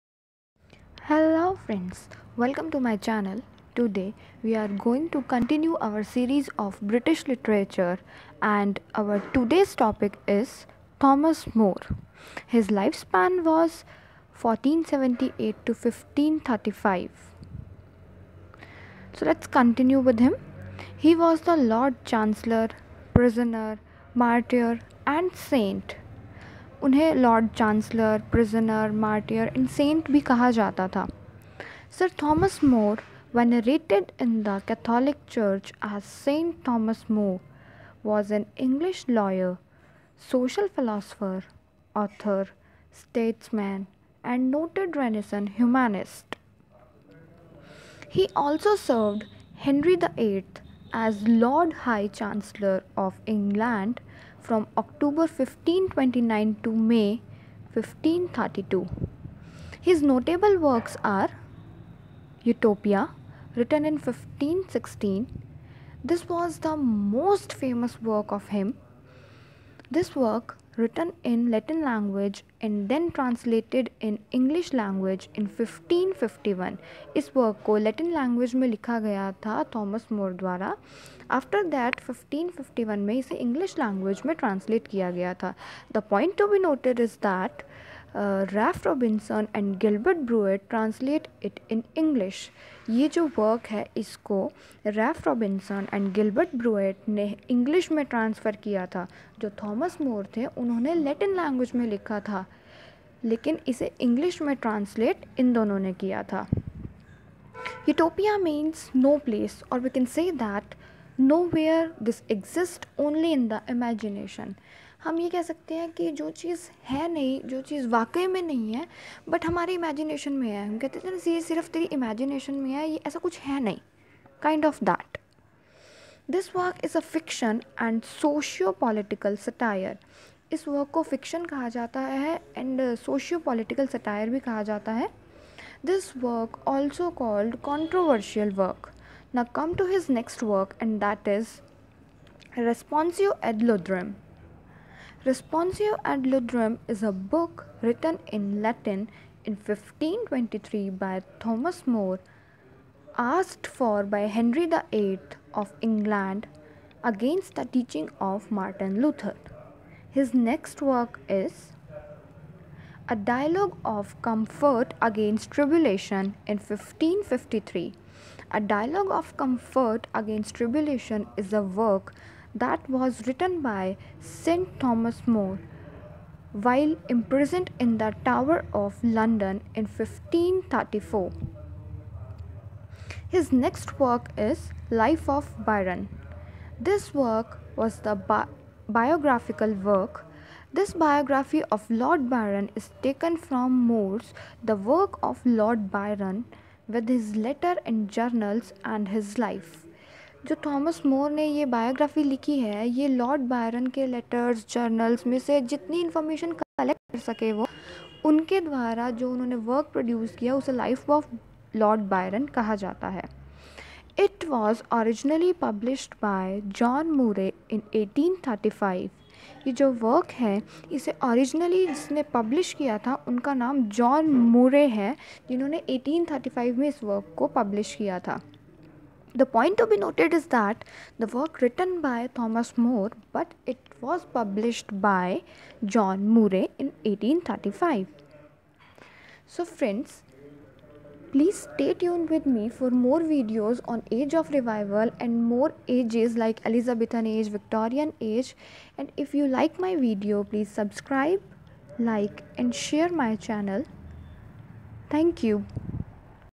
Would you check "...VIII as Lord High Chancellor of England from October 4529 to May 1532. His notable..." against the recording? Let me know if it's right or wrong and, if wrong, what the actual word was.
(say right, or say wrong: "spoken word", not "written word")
wrong: "1529", not "4529".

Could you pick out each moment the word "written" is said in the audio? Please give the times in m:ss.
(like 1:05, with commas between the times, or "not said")
1:03, 1:10, 2:27, 2:53, 3:51.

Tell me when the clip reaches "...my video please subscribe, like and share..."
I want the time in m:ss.
4:09.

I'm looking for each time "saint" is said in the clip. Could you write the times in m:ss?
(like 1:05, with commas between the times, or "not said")
0:25, 0:36.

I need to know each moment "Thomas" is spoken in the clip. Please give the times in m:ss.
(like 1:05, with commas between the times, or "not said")
0:11, 0:32, 0:36, 1:19, 2:31, 2:54, 3:52.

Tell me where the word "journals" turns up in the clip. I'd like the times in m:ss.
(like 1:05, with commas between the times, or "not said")
3:18.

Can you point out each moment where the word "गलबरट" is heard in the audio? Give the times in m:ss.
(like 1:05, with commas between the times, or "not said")
1:29, 1:36.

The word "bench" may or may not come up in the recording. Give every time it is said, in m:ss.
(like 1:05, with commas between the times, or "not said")
not said.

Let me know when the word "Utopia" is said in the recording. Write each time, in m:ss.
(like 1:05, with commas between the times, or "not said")
1:02.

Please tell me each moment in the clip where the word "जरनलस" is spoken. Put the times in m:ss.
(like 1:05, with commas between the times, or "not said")
3:24.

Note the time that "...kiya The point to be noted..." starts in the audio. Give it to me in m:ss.
1:24.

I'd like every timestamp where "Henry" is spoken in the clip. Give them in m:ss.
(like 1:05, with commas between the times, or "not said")
0:49, 2:34.